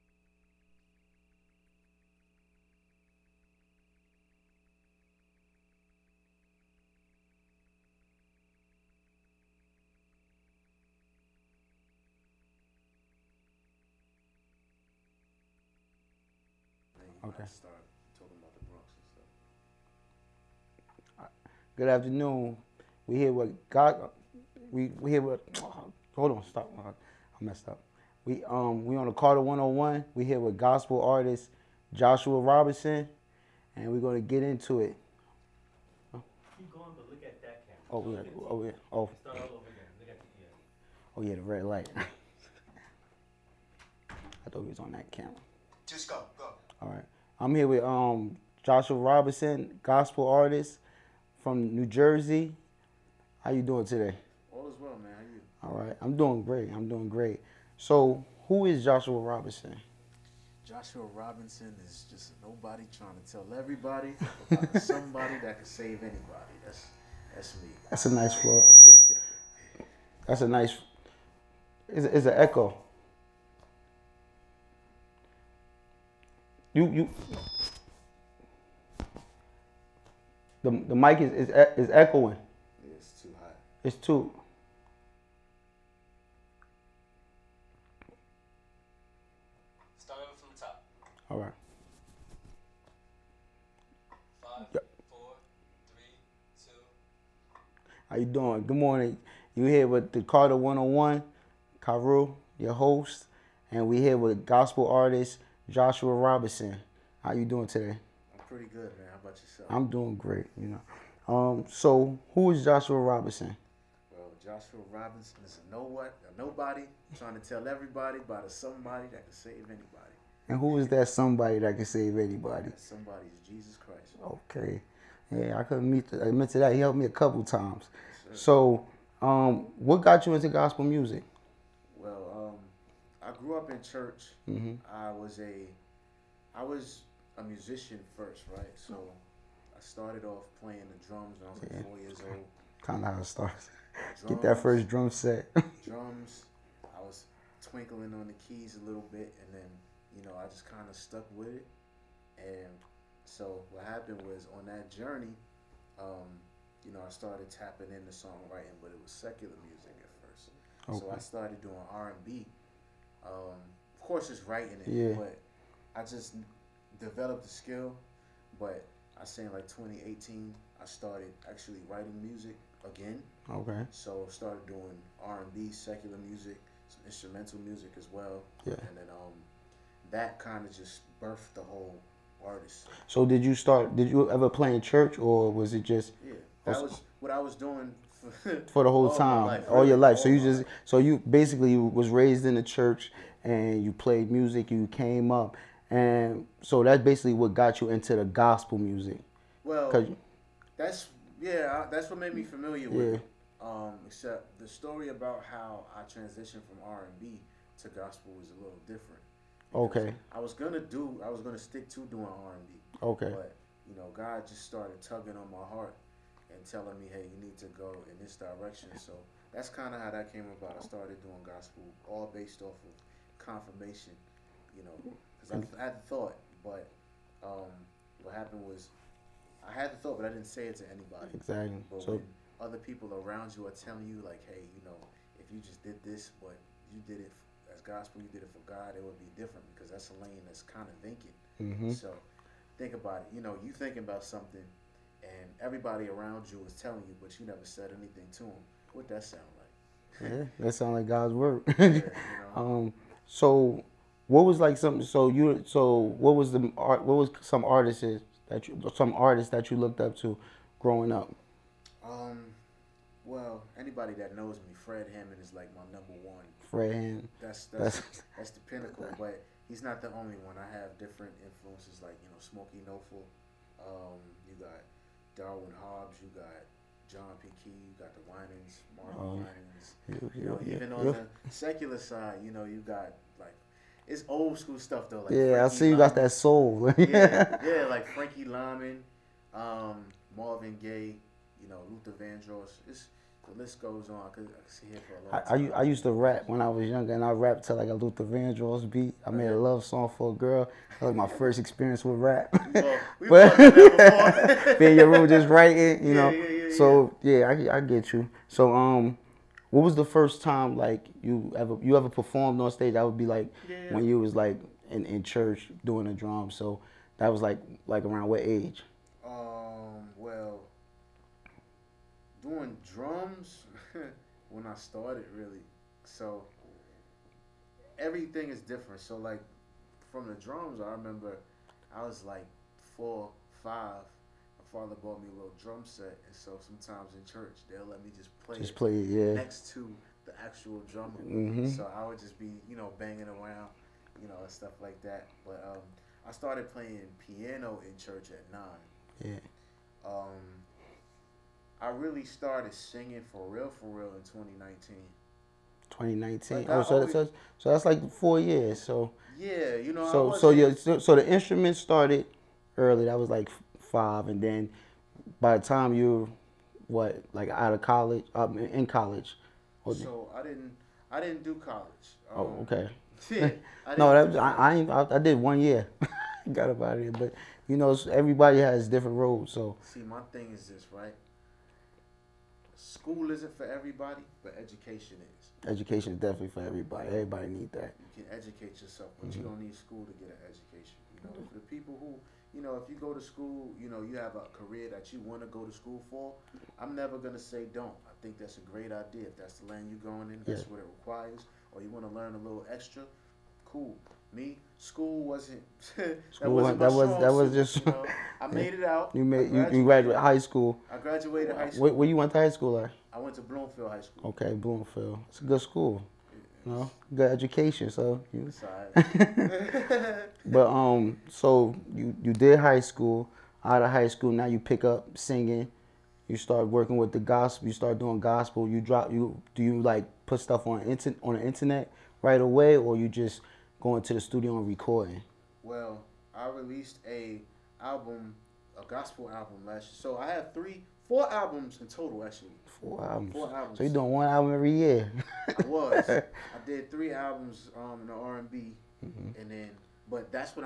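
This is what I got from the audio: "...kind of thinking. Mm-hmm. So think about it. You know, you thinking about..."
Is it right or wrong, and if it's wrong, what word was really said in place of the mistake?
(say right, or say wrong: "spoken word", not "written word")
right.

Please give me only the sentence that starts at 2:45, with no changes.
but I just developed the skill.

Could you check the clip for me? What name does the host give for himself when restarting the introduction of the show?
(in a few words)
Kahru.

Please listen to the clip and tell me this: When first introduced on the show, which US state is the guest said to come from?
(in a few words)
New Jersey.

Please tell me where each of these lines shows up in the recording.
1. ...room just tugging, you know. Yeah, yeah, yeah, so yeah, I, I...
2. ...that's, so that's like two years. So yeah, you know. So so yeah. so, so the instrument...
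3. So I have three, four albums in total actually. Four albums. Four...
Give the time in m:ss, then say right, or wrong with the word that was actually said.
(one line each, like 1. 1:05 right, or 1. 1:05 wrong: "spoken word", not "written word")
1. 5:05 wrong: "writing", not "tugging"
2. 5:57 wrong: "four", not "two"
3. 7:19 right.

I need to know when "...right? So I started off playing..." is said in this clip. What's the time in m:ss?
2:18.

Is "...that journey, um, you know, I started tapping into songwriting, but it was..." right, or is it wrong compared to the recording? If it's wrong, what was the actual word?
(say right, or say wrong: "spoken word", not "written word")
right.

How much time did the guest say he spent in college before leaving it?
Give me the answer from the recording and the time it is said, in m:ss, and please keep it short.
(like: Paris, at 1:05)
1 year, at 6:15.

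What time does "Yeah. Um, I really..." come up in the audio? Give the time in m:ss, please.
5:49.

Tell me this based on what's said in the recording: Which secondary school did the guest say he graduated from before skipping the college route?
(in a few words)
Bloomfield High School.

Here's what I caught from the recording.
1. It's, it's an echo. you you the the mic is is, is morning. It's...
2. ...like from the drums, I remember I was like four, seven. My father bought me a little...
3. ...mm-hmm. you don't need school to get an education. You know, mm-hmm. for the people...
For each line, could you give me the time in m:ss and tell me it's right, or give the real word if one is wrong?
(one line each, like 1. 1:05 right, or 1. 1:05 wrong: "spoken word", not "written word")
1. 1:11 wrong: "echoing", not "morning"
2. 5:29 wrong: "five", not "seven"
3. 6:29 right.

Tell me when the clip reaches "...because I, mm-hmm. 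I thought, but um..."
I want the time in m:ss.
3:45.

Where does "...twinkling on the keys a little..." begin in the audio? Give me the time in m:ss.
2:27.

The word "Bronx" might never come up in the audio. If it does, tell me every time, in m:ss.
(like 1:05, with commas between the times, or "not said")
0:18.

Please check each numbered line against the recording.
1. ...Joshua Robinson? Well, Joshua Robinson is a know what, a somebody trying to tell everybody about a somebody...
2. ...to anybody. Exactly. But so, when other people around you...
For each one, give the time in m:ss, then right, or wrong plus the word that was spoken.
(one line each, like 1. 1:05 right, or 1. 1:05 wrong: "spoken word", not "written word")
1. 1:52 wrong: "nobody", not "somebody"
2. 3:50 right.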